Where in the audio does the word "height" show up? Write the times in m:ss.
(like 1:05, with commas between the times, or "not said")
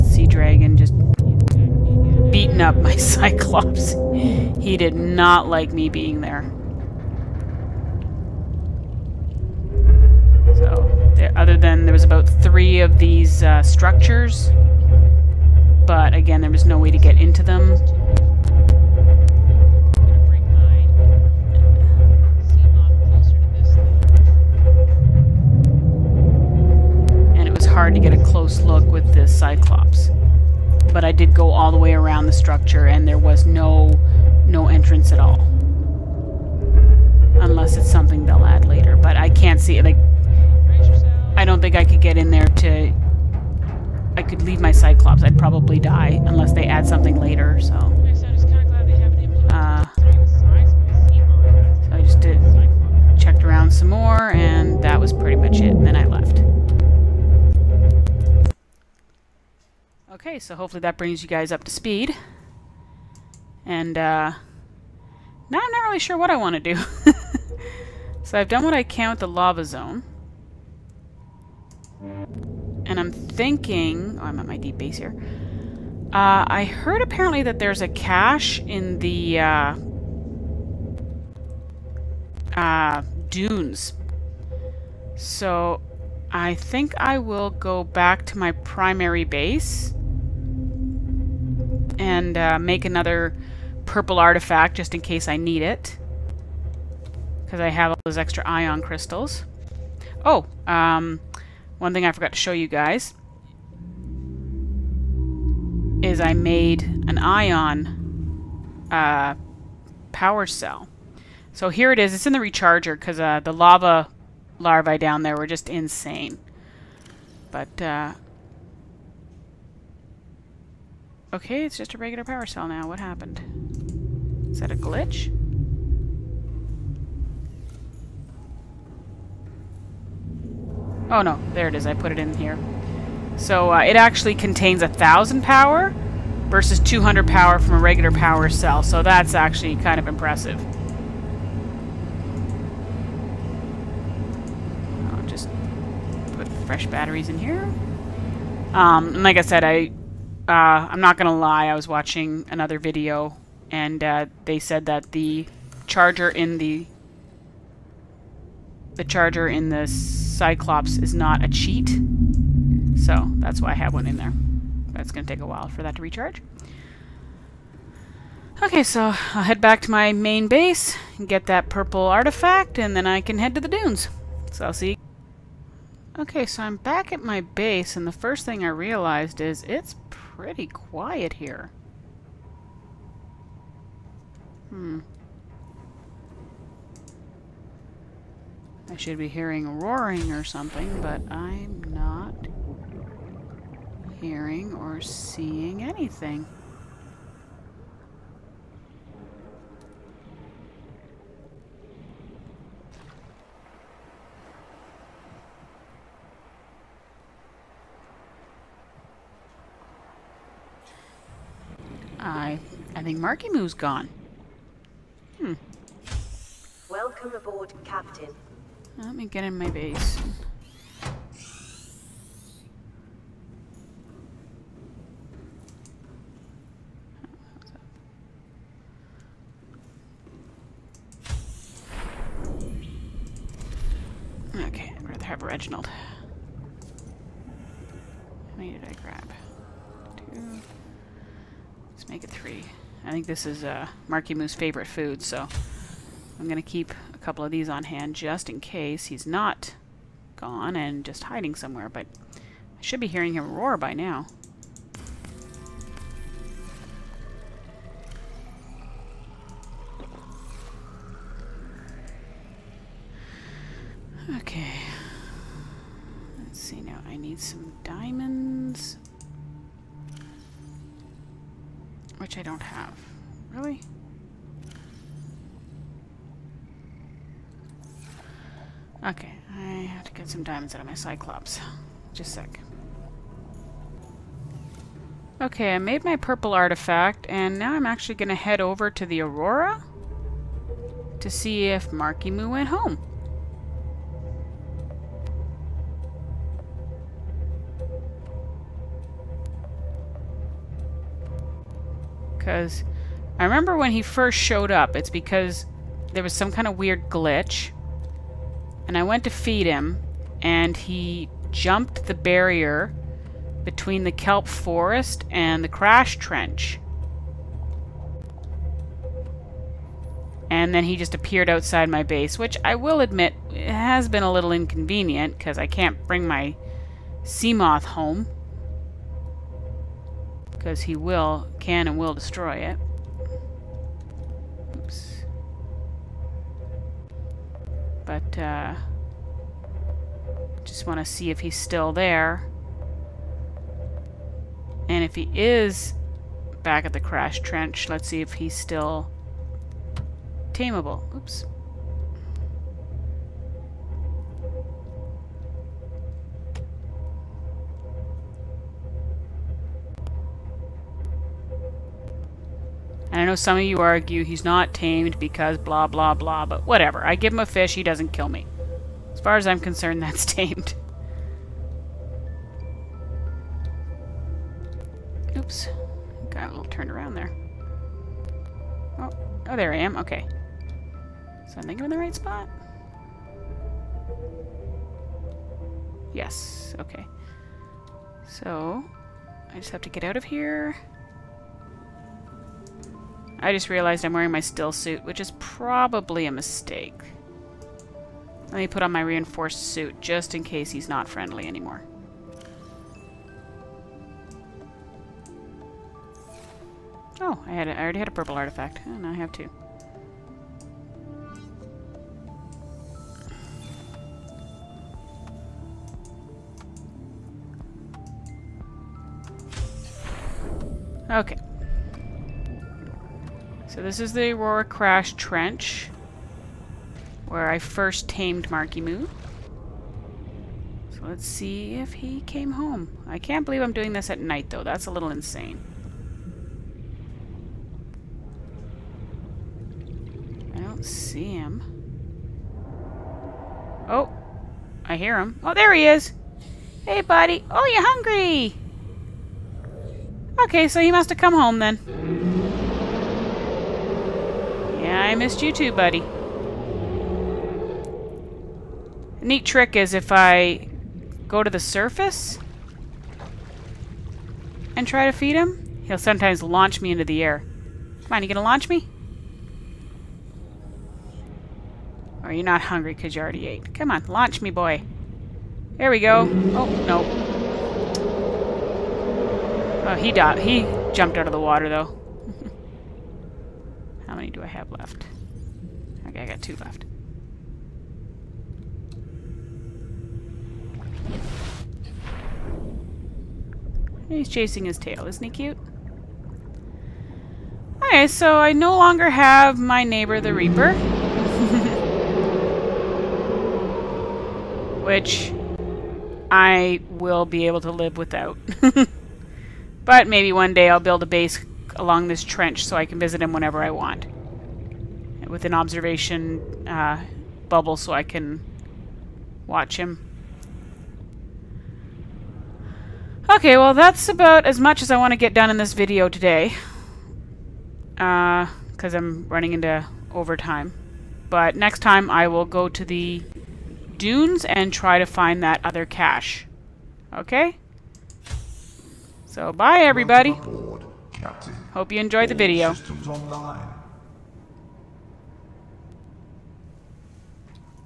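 not said.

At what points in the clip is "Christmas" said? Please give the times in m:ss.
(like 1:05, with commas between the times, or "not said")
not said.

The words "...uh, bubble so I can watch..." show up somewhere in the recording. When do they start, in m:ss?
8:36.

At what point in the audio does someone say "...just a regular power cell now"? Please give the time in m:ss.
2:01.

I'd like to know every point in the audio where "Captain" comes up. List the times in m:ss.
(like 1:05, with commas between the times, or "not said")
3:37, 9:01.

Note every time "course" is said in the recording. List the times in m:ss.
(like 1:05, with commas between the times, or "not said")
not said.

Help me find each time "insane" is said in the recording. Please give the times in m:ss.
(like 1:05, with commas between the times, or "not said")
1:55, 7:15.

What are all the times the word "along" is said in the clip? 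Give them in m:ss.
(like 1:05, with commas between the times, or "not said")
8:31.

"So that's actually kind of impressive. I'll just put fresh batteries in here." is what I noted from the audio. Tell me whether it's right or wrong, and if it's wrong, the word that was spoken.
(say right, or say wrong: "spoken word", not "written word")
right.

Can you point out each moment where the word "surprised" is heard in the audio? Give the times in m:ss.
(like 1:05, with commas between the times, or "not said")
not said.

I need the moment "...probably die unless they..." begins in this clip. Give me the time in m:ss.
0:45.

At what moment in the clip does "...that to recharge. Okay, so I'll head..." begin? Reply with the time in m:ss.
2:45.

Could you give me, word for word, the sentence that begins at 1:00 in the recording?
Okay, so hopefully that brings you guys up to speed.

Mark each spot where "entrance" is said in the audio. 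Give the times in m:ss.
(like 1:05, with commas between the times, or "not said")
0:34.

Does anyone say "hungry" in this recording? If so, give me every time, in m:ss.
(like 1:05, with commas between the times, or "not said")
7:27, 7:52.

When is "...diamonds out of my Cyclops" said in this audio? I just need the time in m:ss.
4:40.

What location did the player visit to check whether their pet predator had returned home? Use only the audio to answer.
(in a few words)
Aurora Crash Trench.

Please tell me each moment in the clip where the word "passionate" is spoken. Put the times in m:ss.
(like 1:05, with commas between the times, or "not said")
not said.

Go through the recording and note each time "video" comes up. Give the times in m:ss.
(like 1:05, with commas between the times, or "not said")
2:32, 8:45, 9:02.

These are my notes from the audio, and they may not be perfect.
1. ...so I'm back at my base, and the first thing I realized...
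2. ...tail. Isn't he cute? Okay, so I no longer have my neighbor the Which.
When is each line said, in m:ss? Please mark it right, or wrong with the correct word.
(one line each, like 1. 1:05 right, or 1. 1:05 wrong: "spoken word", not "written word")
1. 2:56 right
2. 8:14 wrong: "Reaper", not "Which".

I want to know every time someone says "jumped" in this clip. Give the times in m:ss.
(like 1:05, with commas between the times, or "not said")
5:11, 8:00.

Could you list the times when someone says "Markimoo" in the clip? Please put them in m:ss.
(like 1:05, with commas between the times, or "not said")
3:33, 4:04, 4:51, 7:08.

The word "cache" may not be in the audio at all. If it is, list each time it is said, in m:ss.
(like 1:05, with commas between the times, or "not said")
1:17, 8:55.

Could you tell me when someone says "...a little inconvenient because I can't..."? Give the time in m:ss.
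5:24.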